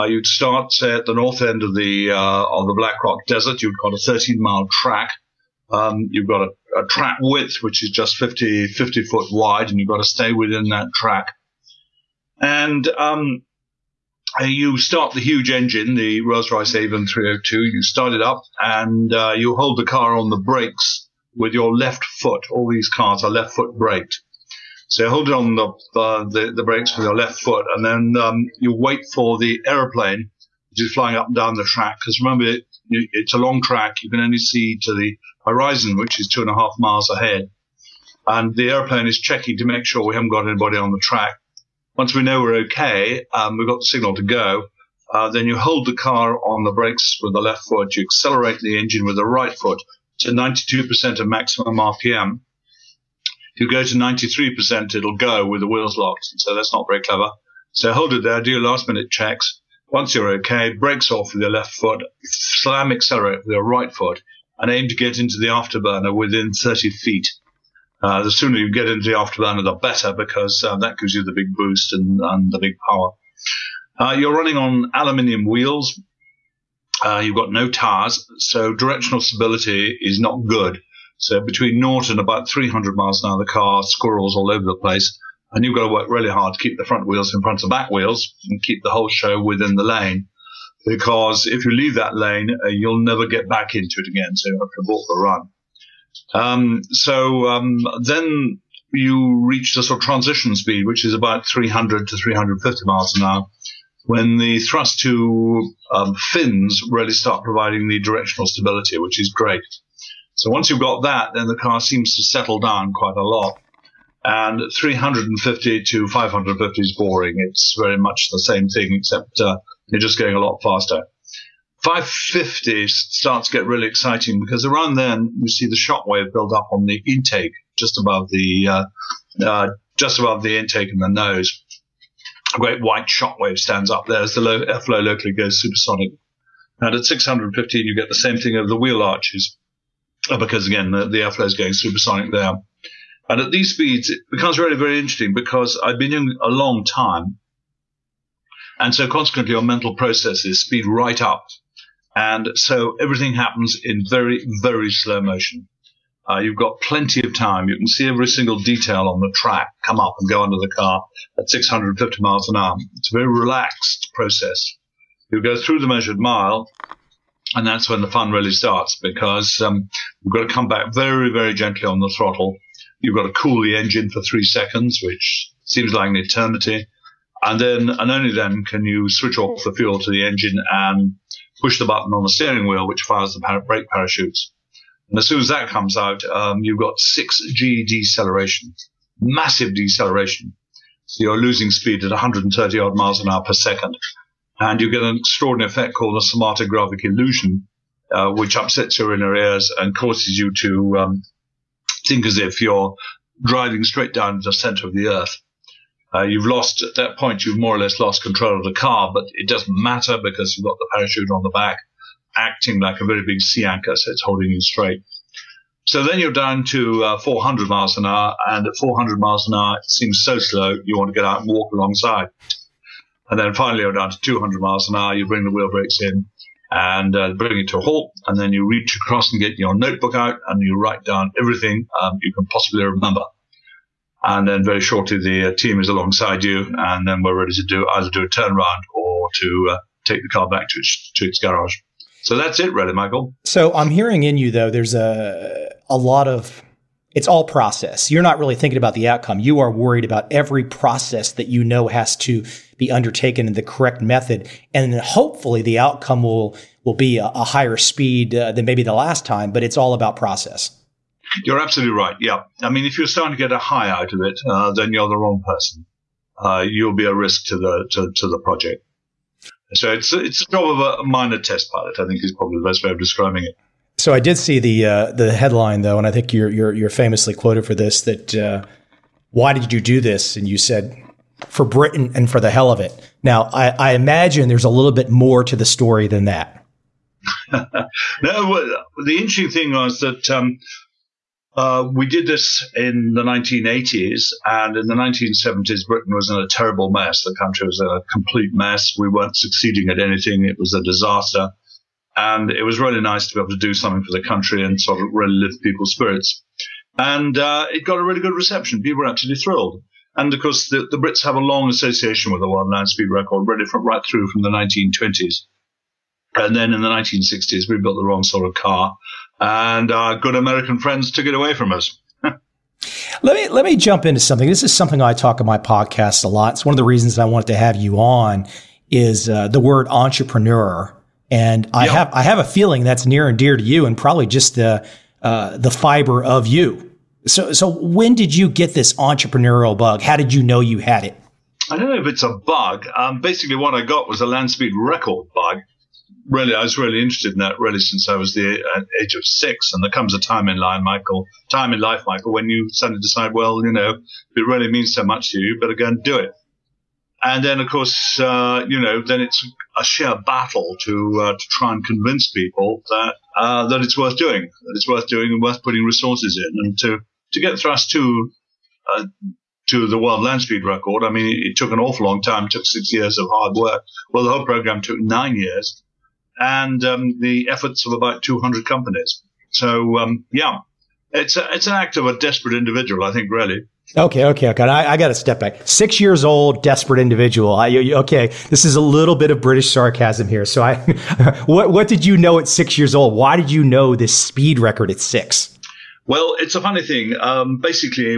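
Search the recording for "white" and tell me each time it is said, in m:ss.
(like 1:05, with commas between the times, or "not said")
2:12.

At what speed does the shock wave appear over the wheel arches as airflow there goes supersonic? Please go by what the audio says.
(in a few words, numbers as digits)
615.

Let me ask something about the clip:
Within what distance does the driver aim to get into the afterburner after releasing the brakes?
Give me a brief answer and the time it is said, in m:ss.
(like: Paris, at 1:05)
30 feet, at 1:06.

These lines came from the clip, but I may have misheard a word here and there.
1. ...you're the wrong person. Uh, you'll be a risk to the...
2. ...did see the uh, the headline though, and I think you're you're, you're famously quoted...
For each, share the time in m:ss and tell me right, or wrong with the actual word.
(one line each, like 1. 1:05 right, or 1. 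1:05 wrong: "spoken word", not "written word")
1. 4:24 right
2. 4:34 right.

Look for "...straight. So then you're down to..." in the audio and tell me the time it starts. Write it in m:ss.
3:34.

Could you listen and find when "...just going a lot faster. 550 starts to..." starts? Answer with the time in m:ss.
2:00.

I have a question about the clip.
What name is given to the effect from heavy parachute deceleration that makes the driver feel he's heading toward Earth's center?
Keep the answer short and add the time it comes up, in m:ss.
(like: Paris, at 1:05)
somatogravic illusion, at 3:16.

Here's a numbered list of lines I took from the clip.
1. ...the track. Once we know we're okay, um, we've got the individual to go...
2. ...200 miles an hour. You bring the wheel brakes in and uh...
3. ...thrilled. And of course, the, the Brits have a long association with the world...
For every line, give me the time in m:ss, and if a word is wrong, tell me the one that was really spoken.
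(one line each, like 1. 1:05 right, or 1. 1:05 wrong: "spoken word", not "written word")
1. 0:40 wrong: "signal", not "individual"
2. 3:44 right
3. 5:09 right.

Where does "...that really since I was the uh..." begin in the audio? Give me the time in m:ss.
5:47.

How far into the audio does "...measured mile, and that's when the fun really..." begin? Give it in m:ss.
2:45.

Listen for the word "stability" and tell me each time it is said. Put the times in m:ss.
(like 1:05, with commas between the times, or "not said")
1:19, 1:48.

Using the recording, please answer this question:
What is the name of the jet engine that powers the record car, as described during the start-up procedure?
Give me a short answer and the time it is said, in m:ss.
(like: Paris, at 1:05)
Rolls Royce Avon 302, at 0:16.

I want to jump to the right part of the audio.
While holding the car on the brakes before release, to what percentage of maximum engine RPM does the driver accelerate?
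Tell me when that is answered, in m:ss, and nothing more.
0:50.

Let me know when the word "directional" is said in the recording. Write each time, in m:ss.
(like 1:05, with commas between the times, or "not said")
1:18, 1:48.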